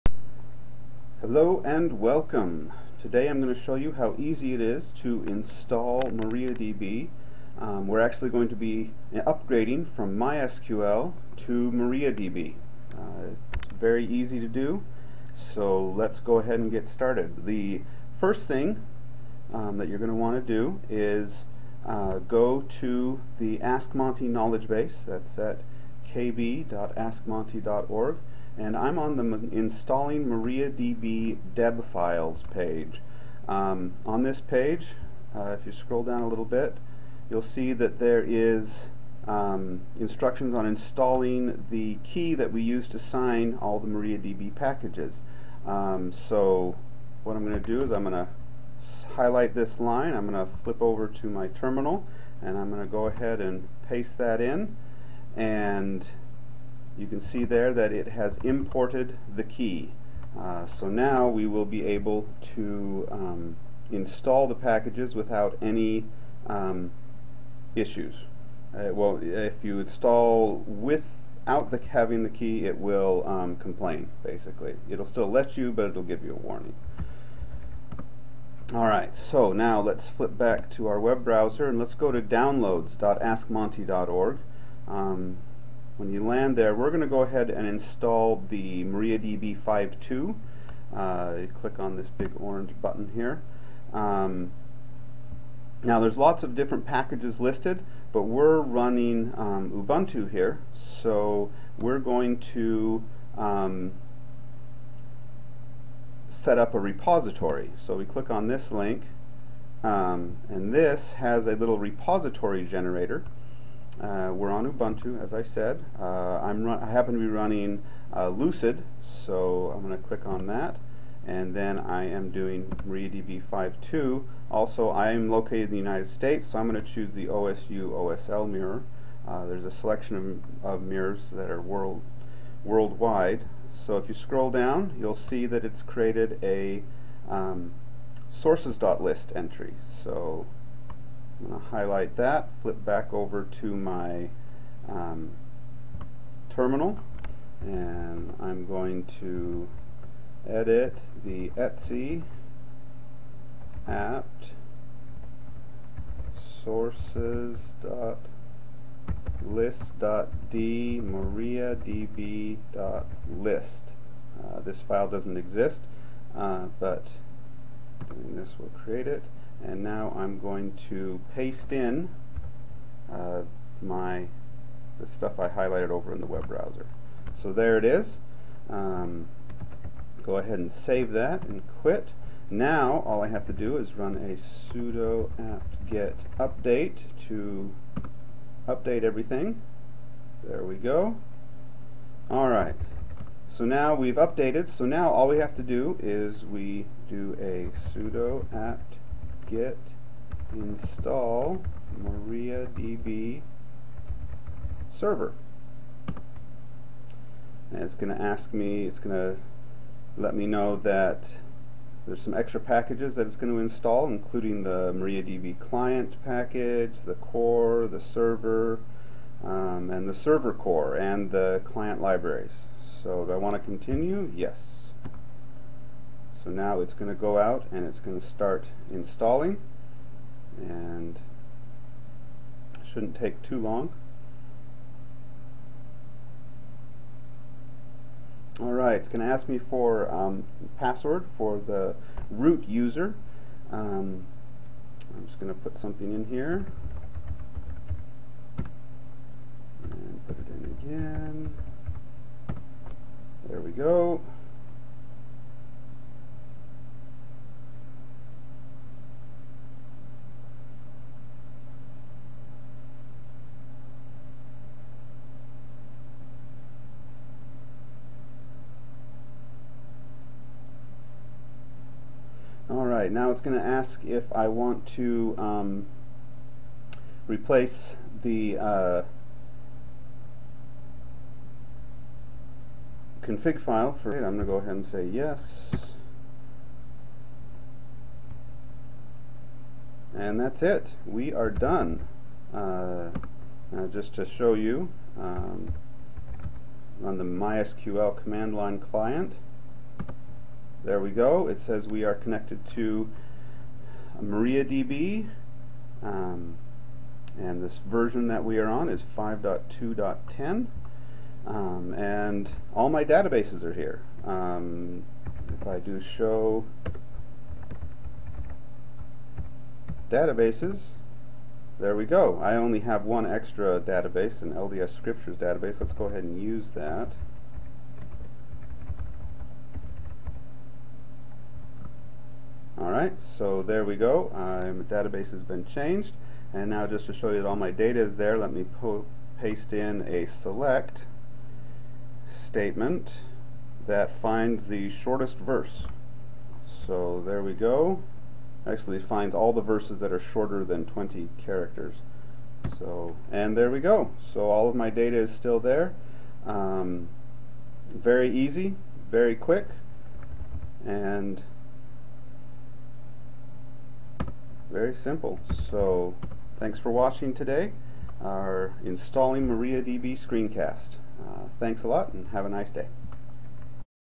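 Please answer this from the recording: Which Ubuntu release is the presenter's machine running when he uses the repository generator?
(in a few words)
Lucid.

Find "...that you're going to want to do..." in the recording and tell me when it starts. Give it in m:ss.
0:19.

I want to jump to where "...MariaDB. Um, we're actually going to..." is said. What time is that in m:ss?
0:06.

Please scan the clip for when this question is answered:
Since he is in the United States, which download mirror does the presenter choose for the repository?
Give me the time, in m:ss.
2:07.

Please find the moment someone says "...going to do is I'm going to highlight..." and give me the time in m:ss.
0:47.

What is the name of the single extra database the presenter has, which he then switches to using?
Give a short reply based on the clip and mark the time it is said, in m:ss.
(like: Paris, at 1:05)
LDS Scriptures, at 5:24.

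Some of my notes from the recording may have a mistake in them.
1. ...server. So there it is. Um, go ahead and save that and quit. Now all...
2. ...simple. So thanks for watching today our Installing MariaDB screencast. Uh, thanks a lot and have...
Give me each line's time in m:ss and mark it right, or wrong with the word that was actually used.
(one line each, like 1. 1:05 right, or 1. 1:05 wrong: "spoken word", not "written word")
1. 2:56 wrong: "browser", not "server"
2. 6:05 right.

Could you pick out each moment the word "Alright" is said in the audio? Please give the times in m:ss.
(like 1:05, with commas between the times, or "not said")
1:18, 3:12, 3:58, 4:33, 5:33.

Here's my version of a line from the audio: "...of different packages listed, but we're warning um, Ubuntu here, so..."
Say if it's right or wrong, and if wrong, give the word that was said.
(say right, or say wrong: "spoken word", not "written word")
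wrong: "running", not "warning".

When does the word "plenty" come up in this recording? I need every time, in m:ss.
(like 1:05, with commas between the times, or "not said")
not said.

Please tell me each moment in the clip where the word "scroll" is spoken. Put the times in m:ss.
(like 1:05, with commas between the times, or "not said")
0:35, 2:14.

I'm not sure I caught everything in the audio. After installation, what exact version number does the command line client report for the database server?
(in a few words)
5.2.10.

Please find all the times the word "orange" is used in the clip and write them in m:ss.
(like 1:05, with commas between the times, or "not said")
1:32.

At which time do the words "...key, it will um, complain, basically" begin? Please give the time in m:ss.
1:12.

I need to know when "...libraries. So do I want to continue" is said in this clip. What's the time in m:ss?
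3:42.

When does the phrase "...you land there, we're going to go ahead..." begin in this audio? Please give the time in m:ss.
1:26.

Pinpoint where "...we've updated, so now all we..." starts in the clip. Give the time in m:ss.
3:13.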